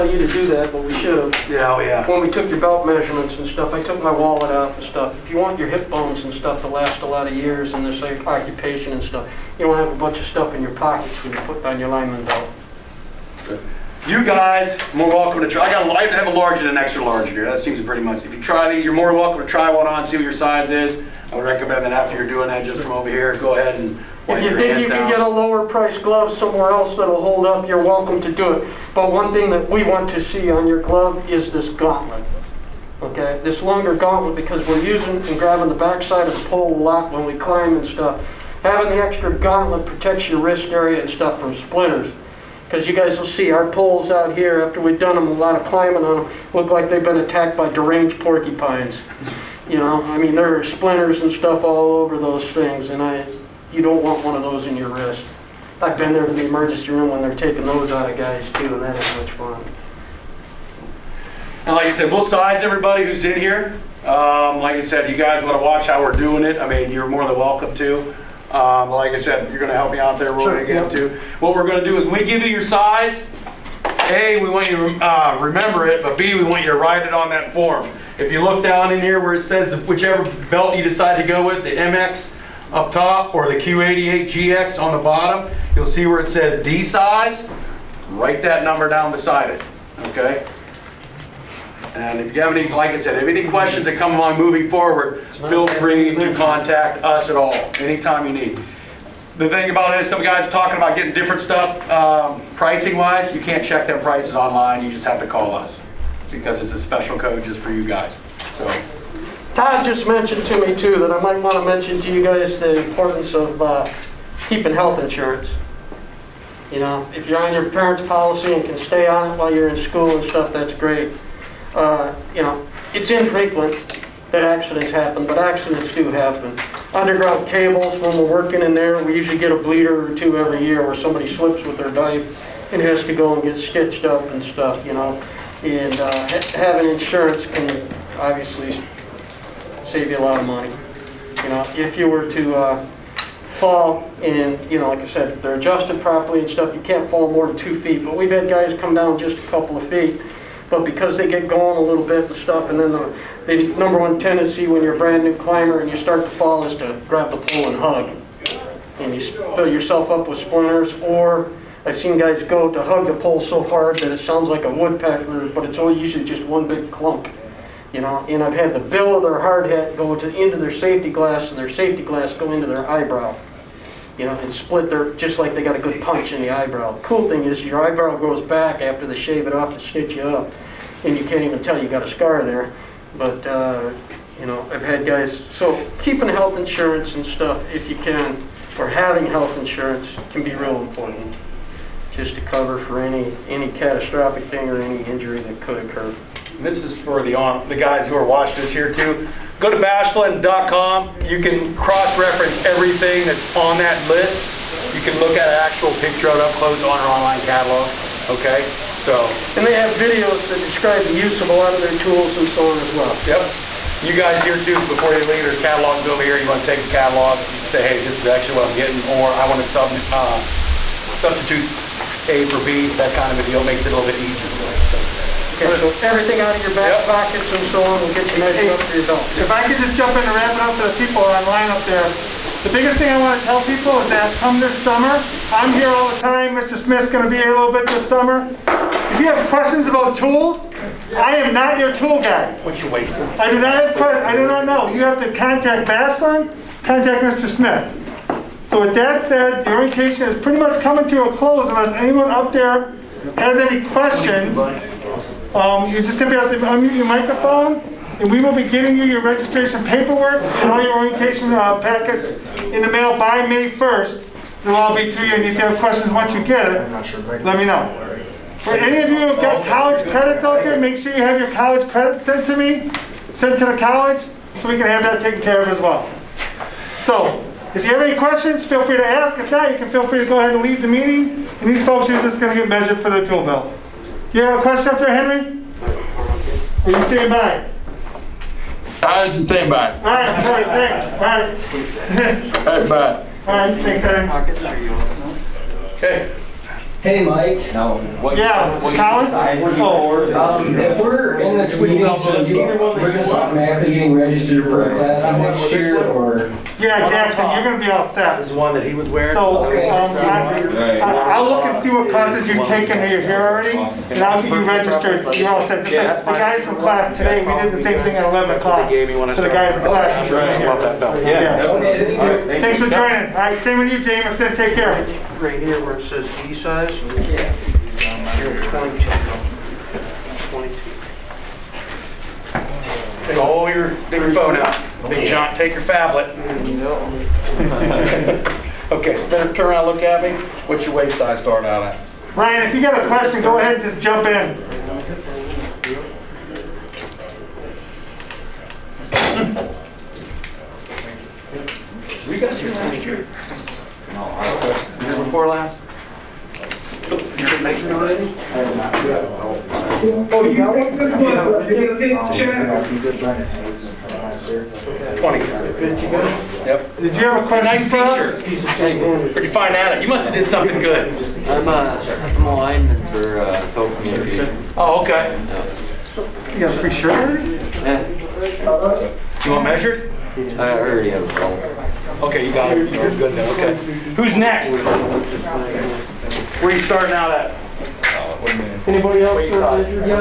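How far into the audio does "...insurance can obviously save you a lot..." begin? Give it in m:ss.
2:16.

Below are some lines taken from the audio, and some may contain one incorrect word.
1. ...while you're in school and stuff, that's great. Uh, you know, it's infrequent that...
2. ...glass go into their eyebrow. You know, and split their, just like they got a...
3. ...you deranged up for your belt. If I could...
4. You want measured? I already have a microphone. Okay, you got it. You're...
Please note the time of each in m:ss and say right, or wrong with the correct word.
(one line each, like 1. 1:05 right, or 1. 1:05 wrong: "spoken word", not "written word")
1. 1:59 right
2. 2:52 right
3. 3:48 wrong: "measured", not "deranged"
4. 6:19 wrong: "phone", not "microphone".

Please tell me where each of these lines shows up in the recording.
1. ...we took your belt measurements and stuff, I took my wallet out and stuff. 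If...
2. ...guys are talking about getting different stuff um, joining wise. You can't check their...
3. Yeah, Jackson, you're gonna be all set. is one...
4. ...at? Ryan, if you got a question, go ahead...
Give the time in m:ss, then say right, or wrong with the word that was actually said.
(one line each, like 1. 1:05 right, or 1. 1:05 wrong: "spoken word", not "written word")
1. 0:02 right
2. 1:40 wrong: "pricing", not "joining"
3. 5:06 right
4. 5:41 right.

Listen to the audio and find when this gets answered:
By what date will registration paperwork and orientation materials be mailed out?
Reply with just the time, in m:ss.
4:23.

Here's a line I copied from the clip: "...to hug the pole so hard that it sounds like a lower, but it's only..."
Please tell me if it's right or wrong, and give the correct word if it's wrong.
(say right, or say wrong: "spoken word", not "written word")
wrong: "woodpecker", not "lower".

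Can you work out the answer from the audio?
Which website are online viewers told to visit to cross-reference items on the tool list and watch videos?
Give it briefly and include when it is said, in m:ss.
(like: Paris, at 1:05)
bashlin.com, at 3:19.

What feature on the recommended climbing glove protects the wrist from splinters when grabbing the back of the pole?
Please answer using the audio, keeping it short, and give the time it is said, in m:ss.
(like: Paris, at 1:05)
longer gauntlet, at 0:33.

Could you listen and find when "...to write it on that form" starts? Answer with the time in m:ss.
1:16.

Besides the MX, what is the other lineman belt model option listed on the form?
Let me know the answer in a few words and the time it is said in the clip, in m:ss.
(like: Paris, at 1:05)
Q88GX, at 1:23.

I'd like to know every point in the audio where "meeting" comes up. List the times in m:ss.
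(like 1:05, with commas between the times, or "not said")
4:40, 5:01.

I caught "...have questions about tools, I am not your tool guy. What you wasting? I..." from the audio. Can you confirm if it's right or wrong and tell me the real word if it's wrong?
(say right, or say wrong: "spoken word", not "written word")
right.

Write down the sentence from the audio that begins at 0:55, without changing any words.
I've been there to the emergency room when they're taking those out of guys too, and that ain't much fun.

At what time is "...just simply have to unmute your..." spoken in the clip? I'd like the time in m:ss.
4:15.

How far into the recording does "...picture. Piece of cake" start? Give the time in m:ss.
6:07.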